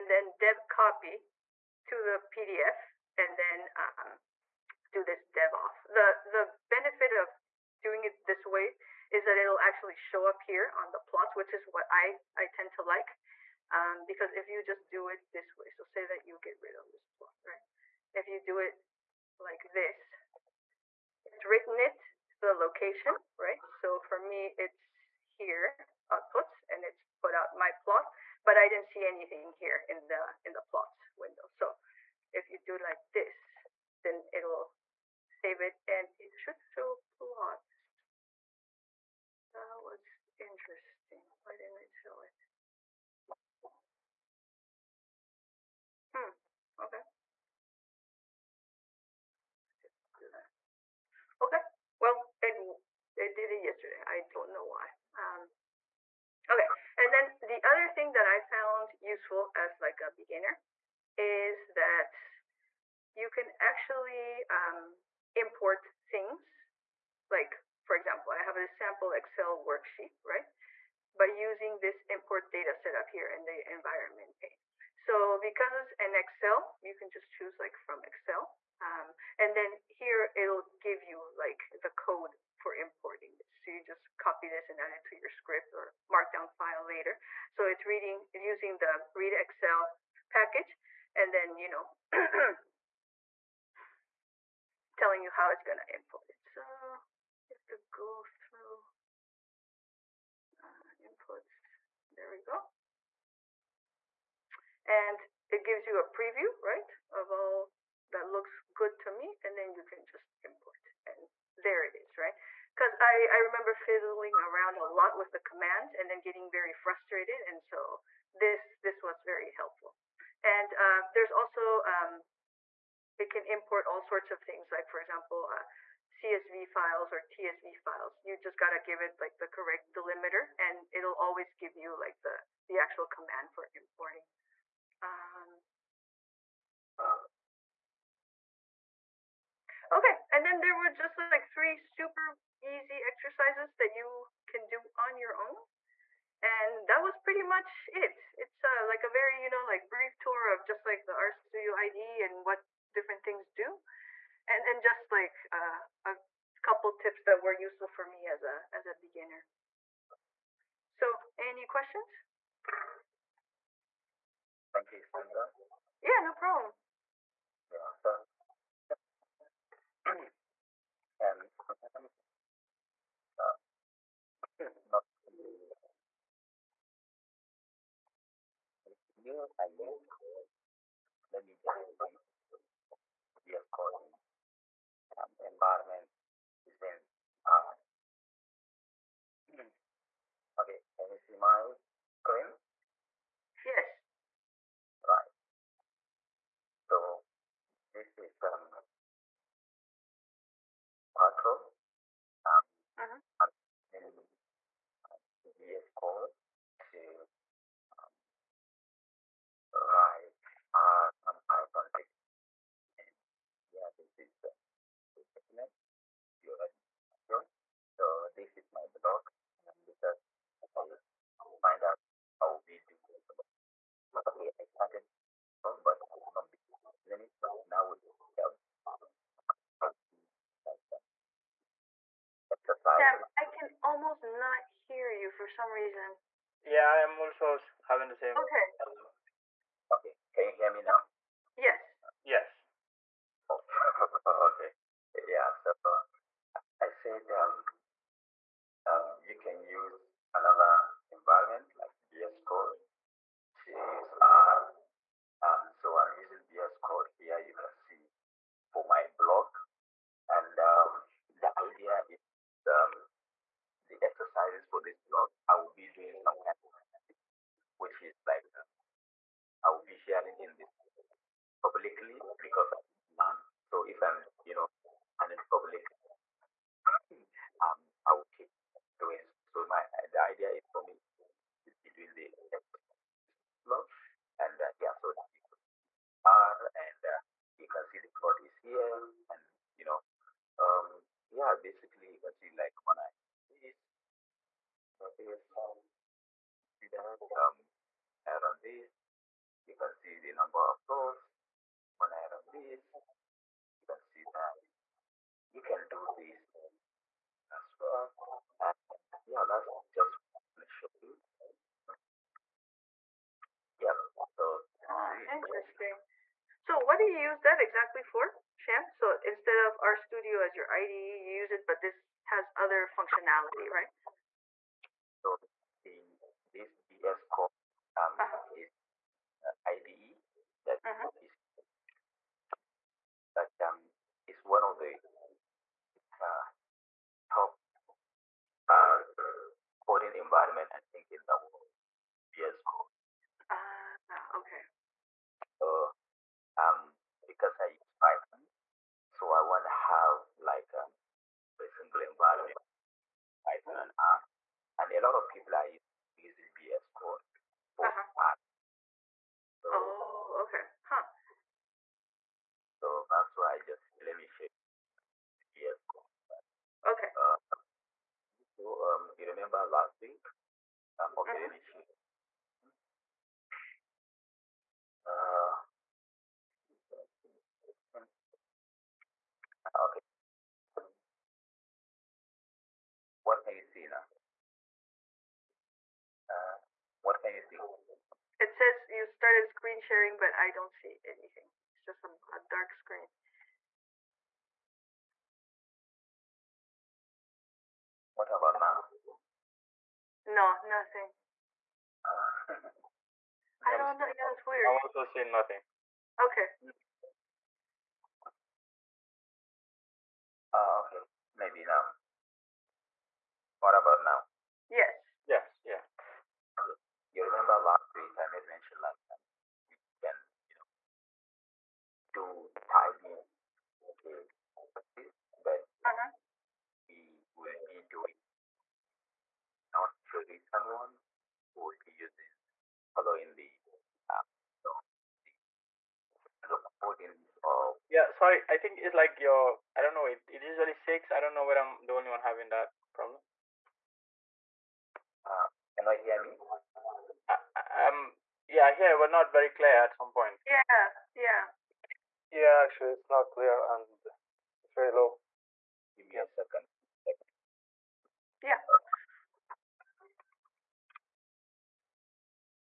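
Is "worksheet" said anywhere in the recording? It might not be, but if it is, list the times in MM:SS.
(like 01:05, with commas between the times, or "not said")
01:09.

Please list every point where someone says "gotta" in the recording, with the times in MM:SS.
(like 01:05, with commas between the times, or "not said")
02:08.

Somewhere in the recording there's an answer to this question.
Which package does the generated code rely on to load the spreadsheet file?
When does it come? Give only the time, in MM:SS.
01:29.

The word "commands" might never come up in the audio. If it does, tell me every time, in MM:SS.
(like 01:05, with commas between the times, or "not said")
01:55, 02:13.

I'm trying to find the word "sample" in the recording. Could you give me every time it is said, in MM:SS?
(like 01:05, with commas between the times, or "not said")
01:08.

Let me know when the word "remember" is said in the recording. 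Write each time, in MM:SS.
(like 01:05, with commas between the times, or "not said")
01:53, 06:09, 06:57.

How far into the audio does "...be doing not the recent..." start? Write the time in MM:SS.
07:07.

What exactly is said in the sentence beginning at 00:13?
Um, because if you just do it this way, so say that you get rid of this plot, right?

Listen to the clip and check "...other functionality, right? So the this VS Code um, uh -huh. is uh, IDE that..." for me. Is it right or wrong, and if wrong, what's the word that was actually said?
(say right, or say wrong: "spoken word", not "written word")
right.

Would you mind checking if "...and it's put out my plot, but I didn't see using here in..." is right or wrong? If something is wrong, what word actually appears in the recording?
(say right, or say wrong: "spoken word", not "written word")
wrong: "anything", not "using".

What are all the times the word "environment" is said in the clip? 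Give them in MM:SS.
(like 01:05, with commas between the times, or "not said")
01:13, 03:05, 04:11, 05:40, 05:52.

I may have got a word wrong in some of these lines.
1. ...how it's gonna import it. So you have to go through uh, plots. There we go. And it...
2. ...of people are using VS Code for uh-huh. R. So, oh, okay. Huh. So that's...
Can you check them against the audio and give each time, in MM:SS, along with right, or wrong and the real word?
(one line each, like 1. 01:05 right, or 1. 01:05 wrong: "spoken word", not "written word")
1. 01:35 wrong: "inputs", not "plots"
2. 05:55 right.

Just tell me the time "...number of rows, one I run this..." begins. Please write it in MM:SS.
05:00.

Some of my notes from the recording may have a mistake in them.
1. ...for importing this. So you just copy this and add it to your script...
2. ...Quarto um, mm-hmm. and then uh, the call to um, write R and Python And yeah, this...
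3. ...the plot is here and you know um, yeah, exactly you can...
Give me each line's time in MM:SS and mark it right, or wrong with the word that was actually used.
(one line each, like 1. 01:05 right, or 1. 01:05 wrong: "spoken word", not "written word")
1. 01:22 right
2. 03:21 right
3. 04:48 wrong: "basically", not "exactly".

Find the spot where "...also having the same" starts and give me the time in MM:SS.
03:57.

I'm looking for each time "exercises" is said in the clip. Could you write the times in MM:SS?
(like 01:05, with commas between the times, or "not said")
02:23, 04:24, 04:42.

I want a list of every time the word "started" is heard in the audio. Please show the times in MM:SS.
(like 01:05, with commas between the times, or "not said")
03:44, 06:29.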